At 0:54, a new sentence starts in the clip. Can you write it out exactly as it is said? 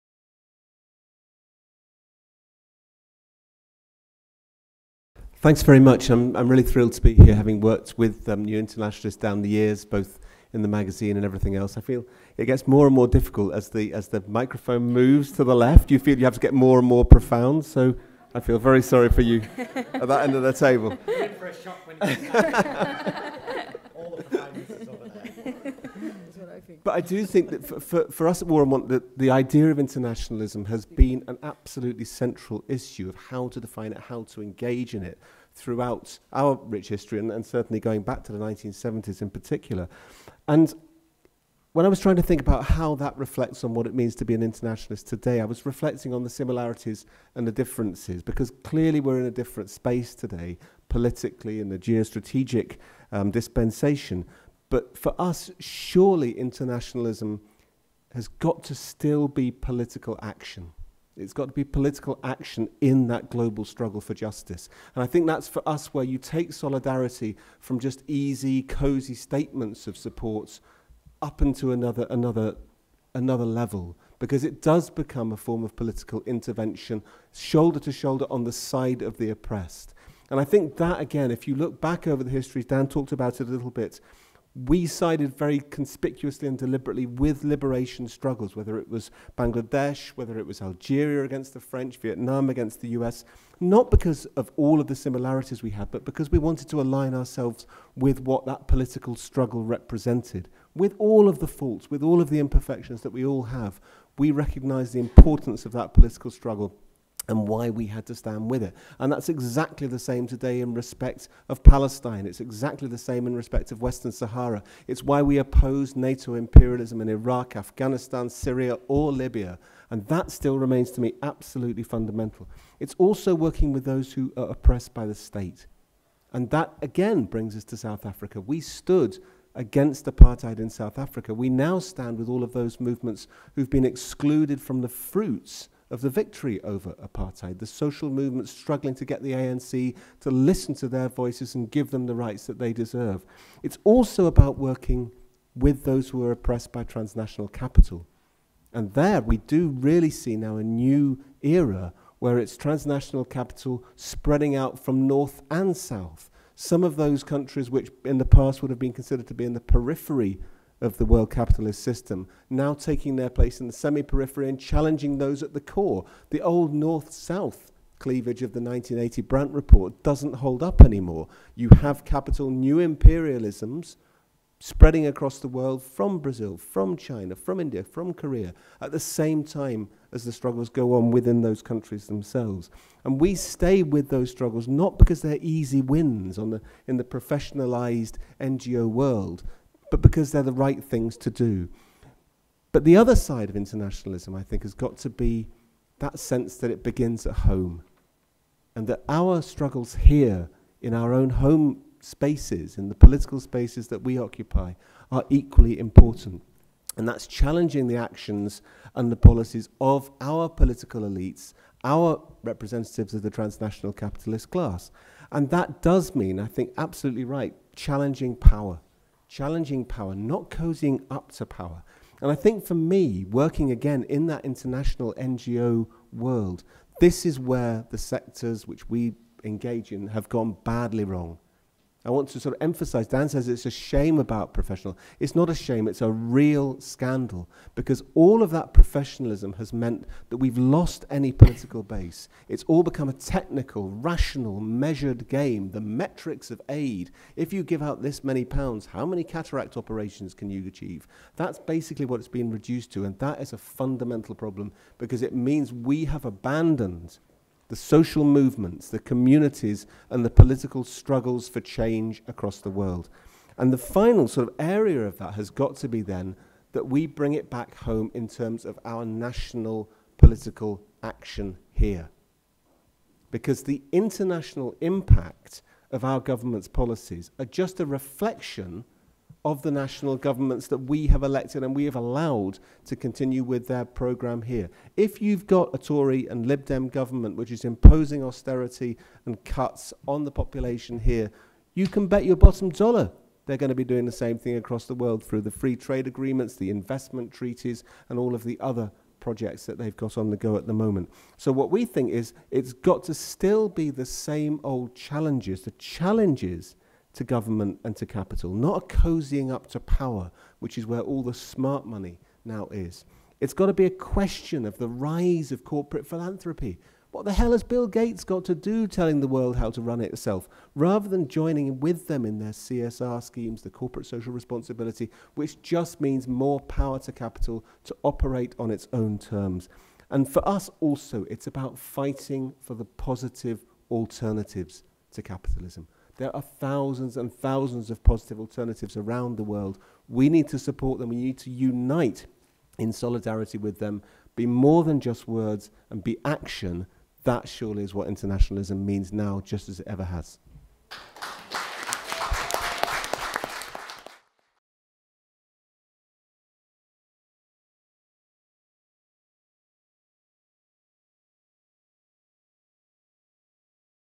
But for us, surely internationalism has got to still be political action.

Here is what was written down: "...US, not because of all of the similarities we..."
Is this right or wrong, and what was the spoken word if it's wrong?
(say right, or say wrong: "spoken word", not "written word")
right.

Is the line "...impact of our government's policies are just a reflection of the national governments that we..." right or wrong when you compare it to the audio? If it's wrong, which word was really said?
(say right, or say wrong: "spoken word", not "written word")
right.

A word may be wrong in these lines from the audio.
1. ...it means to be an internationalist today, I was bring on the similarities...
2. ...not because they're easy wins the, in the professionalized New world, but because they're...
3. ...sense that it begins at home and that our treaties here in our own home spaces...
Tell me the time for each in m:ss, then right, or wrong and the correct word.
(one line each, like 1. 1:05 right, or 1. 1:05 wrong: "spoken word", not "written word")
1. 0:43 wrong: "reflecting", not "bring"
2. 3:04 wrong: "NGO", not "New"
3. 3:16 wrong: "struggles", not "treaties".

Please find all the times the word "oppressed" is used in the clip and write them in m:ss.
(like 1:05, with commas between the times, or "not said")
1:19, 2:04, 2:26.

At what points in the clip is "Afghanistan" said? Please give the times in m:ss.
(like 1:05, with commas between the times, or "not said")
1:57.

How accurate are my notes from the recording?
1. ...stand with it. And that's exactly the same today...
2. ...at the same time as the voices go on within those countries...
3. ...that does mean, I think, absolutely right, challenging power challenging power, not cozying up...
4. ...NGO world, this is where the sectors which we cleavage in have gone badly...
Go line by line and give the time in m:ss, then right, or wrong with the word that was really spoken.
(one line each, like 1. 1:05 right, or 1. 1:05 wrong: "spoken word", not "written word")
1. 1:48 right
2. 2:58 wrong: "struggles", not "voices"
3. 3:35 right
4. 3:45 wrong: "engage", not "cleavage".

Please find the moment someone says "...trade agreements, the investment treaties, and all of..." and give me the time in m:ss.
4:55.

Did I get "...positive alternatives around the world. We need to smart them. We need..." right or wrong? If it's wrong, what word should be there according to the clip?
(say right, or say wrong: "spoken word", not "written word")
wrong: "support", not "smart".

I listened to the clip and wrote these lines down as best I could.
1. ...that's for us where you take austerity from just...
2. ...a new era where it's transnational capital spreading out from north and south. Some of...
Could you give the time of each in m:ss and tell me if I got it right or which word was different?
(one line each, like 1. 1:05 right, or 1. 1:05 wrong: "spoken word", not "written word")
1. 1:05 wrong: "solidarity", not "austerity"
2. 2:30 right.